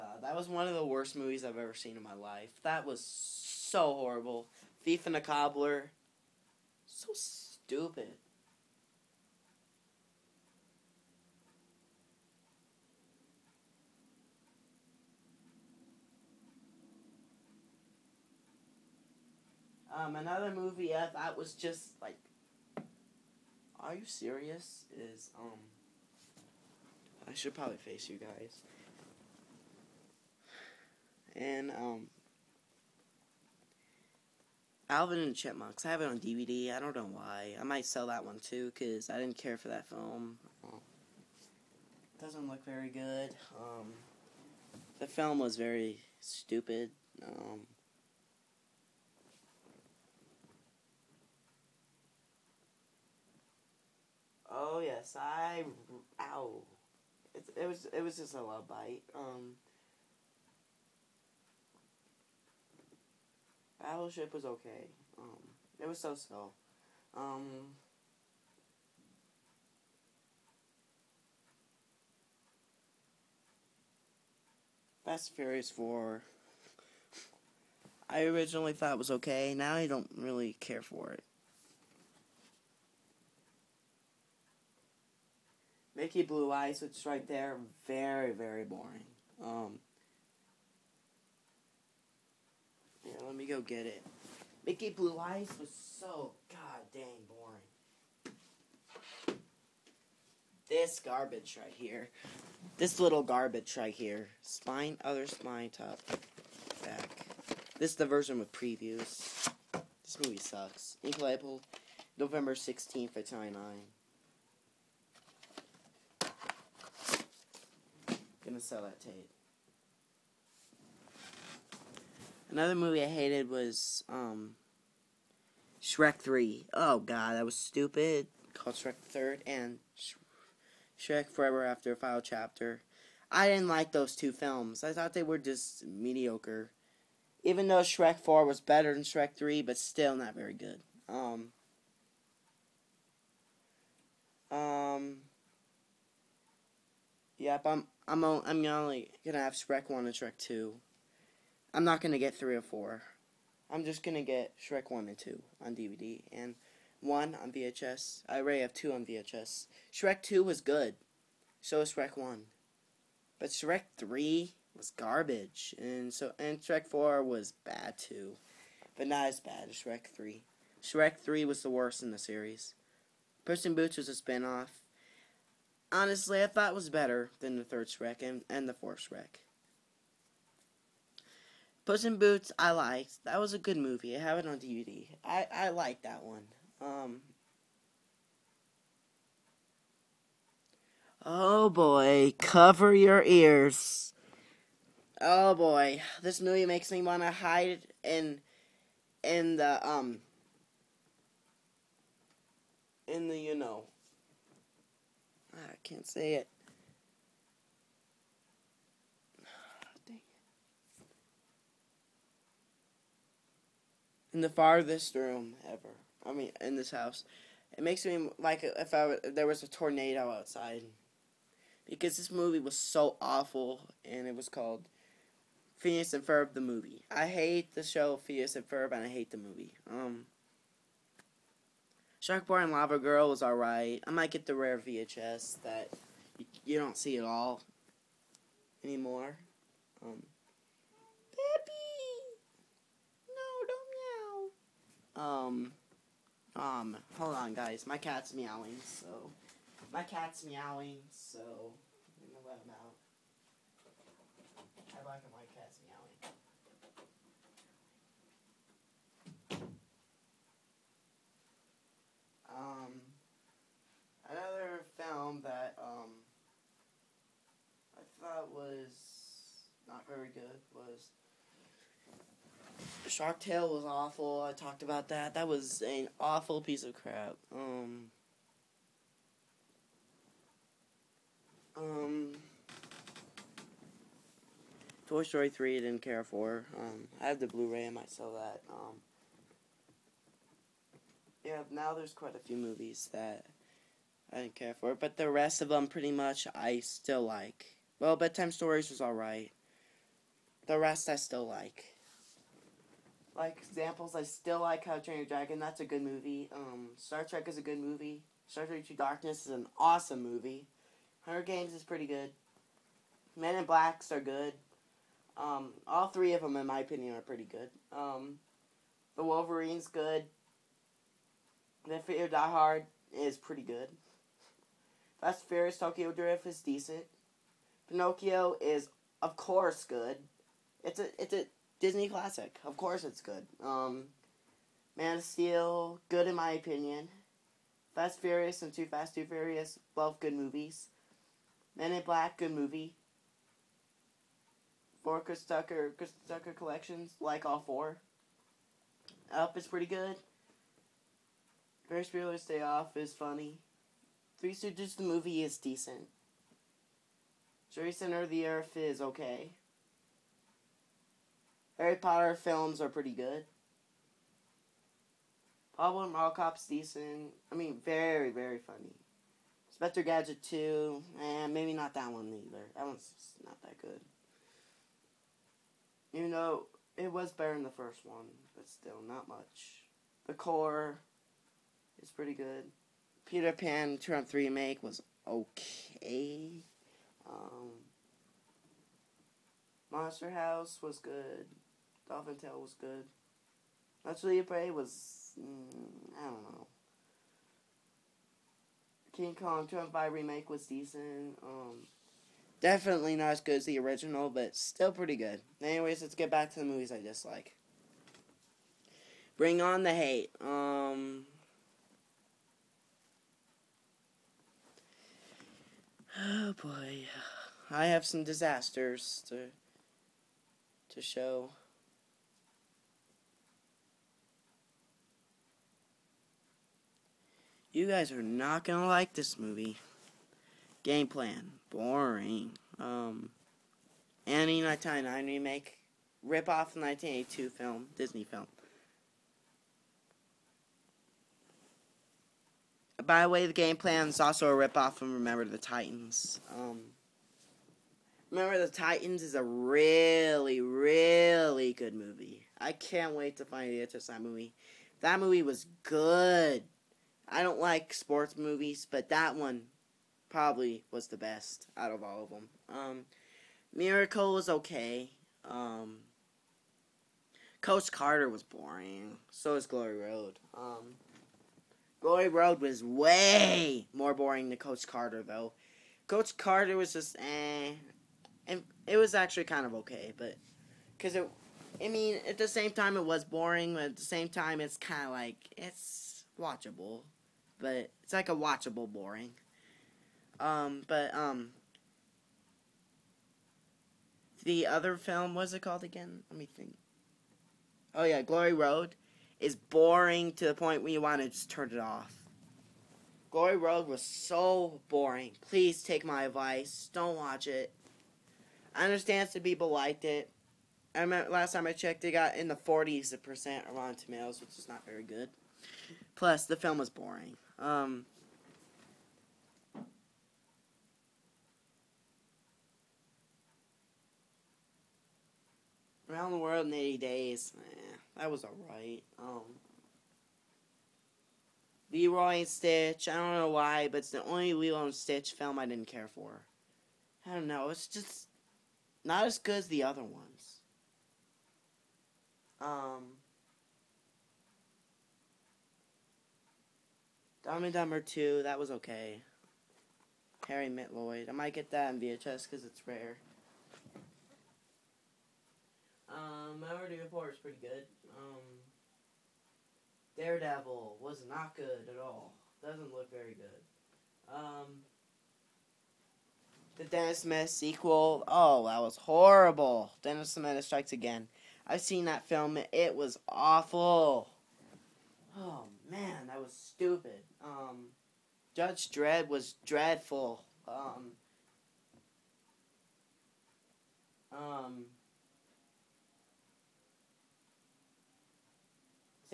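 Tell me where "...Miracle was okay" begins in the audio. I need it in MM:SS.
07:43.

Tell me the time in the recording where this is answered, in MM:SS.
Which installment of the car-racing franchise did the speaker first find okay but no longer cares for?
01:15.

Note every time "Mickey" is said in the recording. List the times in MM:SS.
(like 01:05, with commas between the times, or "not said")
01:25, 01:34.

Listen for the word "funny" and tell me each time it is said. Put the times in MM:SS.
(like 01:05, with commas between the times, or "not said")
05:53, 06:08.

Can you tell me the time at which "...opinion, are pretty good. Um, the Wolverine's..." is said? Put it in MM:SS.
05:16.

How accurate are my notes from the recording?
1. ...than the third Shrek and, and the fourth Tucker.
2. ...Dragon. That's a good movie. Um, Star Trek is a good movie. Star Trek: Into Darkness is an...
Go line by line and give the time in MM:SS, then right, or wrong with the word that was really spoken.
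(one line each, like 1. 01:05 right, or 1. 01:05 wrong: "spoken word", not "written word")
1. 02:57 wrong: "Shrek", not "Tucker"
2. 05:05 right.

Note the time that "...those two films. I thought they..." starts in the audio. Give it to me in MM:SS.
02:13.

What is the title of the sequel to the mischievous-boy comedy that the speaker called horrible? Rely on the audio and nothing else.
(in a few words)
Dennis the Menace Strikes Again.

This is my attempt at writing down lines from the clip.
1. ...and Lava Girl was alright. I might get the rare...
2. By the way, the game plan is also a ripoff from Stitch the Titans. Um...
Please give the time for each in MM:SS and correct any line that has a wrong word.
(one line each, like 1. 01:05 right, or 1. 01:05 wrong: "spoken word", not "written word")
1. 03:52 right
2. 07:23 wrong: "Remember", not "Stitch".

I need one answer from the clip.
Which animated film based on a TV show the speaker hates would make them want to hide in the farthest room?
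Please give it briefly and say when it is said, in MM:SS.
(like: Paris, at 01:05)
Phineas and Ferb the movie, at 03:45.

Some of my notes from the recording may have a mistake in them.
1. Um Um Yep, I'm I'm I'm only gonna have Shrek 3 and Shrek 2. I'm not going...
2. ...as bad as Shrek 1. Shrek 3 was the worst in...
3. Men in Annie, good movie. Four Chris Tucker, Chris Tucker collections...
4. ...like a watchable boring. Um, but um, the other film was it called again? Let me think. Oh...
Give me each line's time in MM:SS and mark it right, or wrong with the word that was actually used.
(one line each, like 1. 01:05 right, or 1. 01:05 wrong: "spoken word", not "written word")
1. 02:21 wrong: "1", not "3"
2. 02:49 wrong: "3", not "1"
3. 05:41 wrong: "Black", not "Annie"
4. 08:08 right.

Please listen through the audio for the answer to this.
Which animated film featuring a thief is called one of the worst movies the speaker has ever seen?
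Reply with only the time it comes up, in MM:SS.
00:04.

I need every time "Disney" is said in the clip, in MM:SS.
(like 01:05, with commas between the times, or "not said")
05:31, 07:17.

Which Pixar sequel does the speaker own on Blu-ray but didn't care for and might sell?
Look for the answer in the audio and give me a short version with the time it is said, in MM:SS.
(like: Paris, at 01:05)
Toy Story 3, at 04:45.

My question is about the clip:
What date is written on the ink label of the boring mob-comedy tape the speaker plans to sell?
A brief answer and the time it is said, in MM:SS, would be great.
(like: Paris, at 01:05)
November 16th, at 01:52.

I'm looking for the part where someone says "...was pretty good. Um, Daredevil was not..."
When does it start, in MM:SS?
09:17.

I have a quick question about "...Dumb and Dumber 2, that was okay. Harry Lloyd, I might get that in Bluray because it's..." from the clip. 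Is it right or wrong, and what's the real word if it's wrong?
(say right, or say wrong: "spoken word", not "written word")
wrong: "VHS", not "Bluray".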